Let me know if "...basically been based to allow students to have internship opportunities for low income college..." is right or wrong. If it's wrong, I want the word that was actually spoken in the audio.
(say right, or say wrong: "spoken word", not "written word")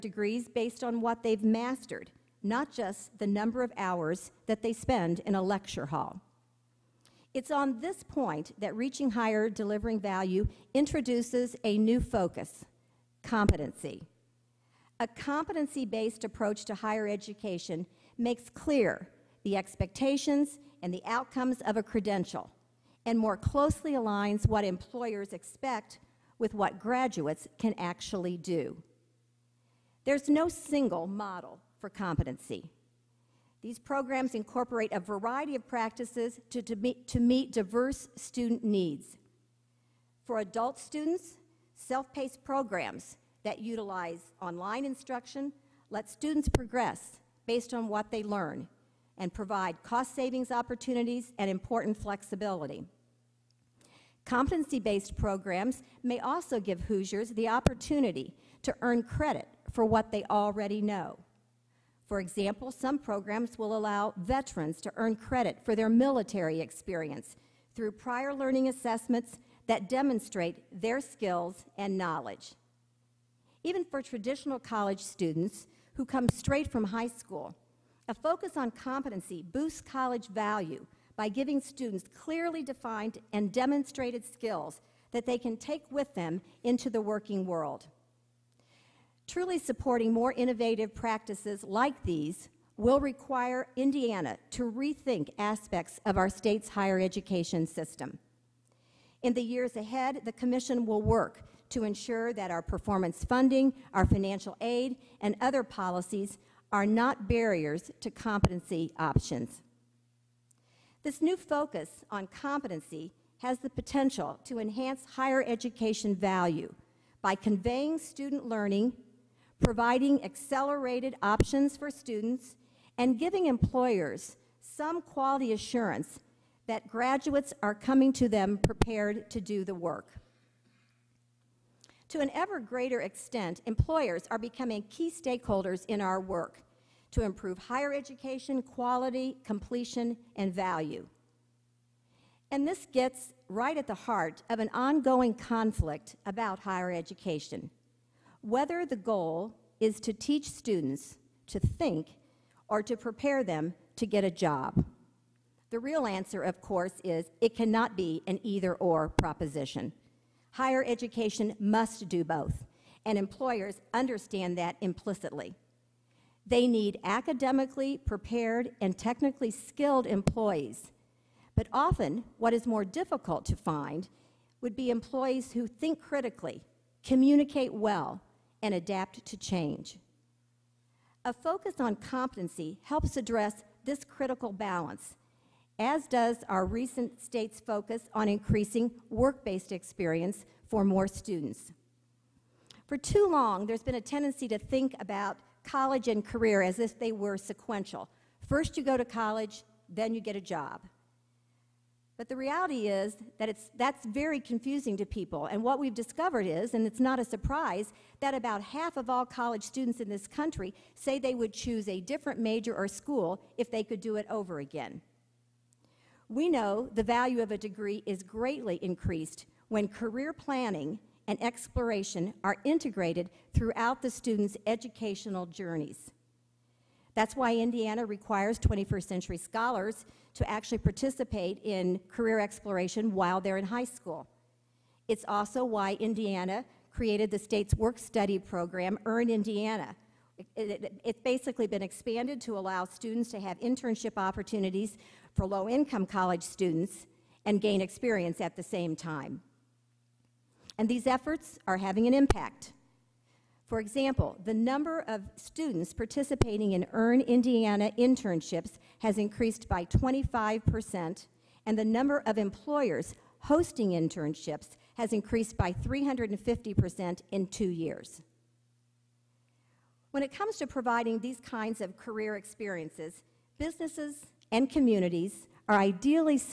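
wrong: "expanded", not "based".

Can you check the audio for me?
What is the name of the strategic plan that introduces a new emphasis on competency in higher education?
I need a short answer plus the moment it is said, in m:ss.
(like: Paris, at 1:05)
Reaching Higher Delivering Value, at 0:08.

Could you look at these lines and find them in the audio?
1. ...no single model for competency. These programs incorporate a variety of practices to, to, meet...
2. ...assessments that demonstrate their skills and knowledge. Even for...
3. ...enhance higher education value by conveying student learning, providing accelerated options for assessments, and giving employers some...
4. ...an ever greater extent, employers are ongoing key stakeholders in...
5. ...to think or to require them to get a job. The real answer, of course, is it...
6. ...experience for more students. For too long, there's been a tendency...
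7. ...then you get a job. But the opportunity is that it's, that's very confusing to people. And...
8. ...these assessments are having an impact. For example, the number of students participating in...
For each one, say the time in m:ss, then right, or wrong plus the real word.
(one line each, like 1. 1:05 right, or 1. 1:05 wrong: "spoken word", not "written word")
1. 0:30 right
2. 1:08 right
3. 1:54 wrong: "students", not "assessments"
4. 2:12 wrong: "becoming", not "ongoing"
5. 2:31 wrong: "prepare", not "require"
6. 3:09 right
7. 3:19 wrong: "reality", not "opportunity"
8. 4:10 wrong: "efforts", not "assessments".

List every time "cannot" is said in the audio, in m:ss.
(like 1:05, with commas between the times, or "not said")
2:37.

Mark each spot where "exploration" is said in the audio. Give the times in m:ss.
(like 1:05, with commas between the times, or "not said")
3:41, 3:52.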